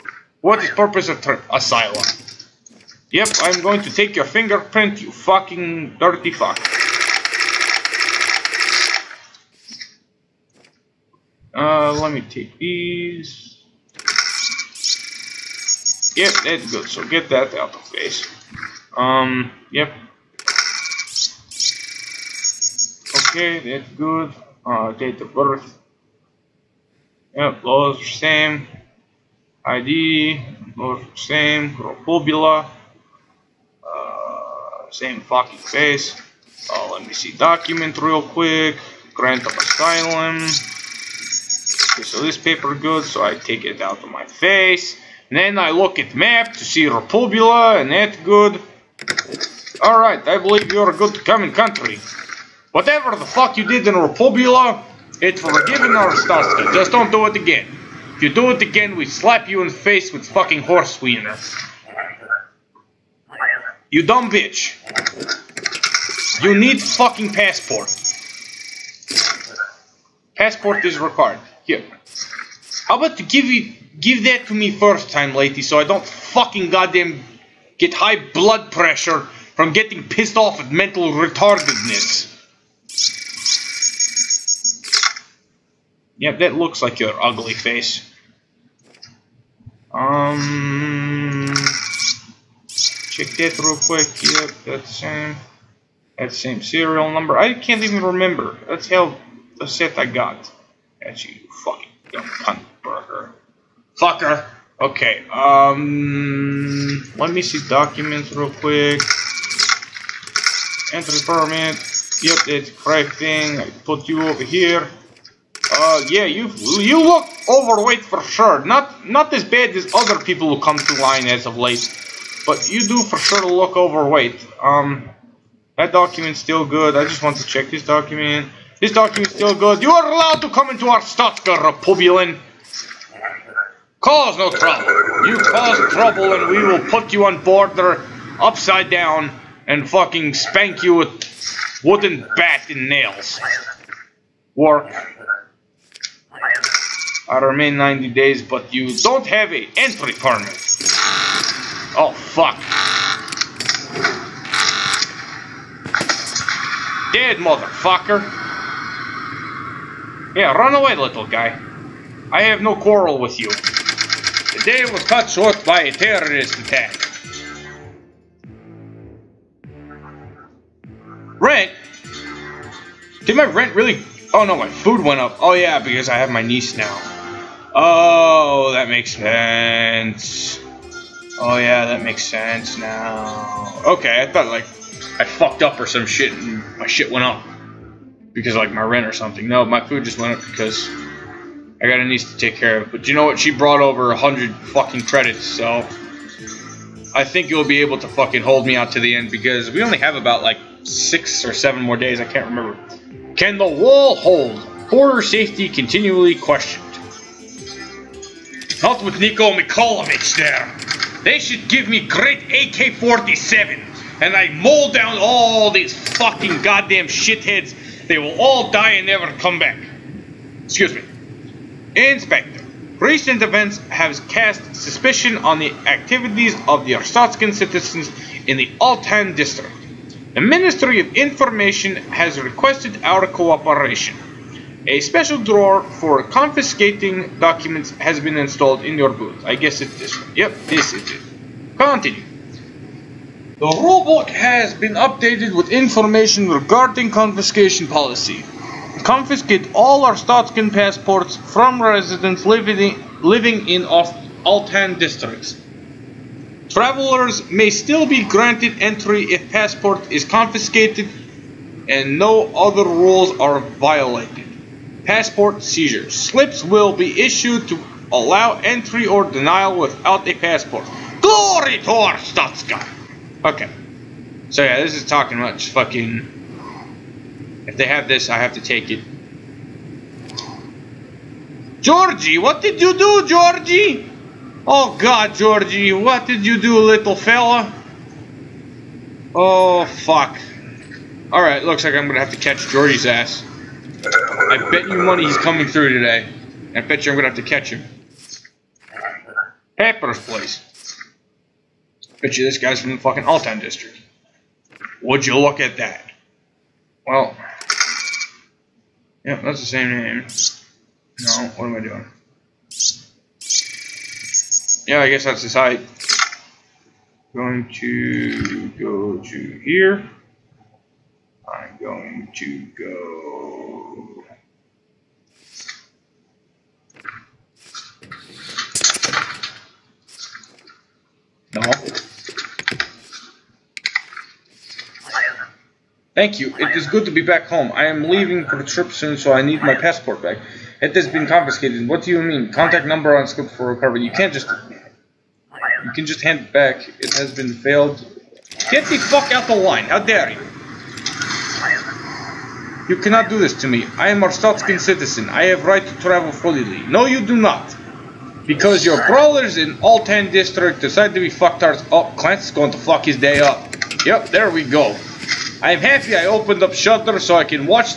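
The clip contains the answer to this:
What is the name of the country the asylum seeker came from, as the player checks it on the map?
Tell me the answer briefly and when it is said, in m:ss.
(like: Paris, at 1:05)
Repubula, at 0:46.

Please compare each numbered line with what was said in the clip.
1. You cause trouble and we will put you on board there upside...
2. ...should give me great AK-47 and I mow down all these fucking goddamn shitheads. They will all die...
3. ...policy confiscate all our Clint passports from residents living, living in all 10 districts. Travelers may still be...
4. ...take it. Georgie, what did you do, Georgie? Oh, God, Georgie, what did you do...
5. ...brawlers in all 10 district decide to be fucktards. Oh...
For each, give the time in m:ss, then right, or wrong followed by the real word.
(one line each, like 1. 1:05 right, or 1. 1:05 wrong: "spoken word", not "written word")
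1. 2:15 right
2. 3:31 right
3. 4:07 wrong: "Stotskin", not "Clint"
4. 4:38 right
5. 5:59 right.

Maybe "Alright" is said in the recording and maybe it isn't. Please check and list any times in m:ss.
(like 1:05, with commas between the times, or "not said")
0:49, 4:51.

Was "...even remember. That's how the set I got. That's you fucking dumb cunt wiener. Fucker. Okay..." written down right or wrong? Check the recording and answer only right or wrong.
wrong.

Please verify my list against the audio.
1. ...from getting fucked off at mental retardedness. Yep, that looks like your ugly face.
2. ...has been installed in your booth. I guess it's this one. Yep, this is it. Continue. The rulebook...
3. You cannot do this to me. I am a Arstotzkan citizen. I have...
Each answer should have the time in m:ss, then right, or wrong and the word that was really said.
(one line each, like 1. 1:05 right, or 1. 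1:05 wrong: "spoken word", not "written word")
1. 1:19 wrong: "pissed", not "fucked"
2. 3:57 right
3. 5:52 right.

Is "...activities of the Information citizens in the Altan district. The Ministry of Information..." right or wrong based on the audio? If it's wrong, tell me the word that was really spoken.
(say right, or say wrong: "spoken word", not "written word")
wrong: "Arstotzkan", not "Information".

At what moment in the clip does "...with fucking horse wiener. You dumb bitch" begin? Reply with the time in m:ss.
1:00.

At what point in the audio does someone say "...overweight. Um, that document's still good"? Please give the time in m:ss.
2:03.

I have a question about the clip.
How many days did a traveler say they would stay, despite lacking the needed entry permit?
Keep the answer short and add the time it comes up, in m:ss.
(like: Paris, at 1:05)
90, at 2:27.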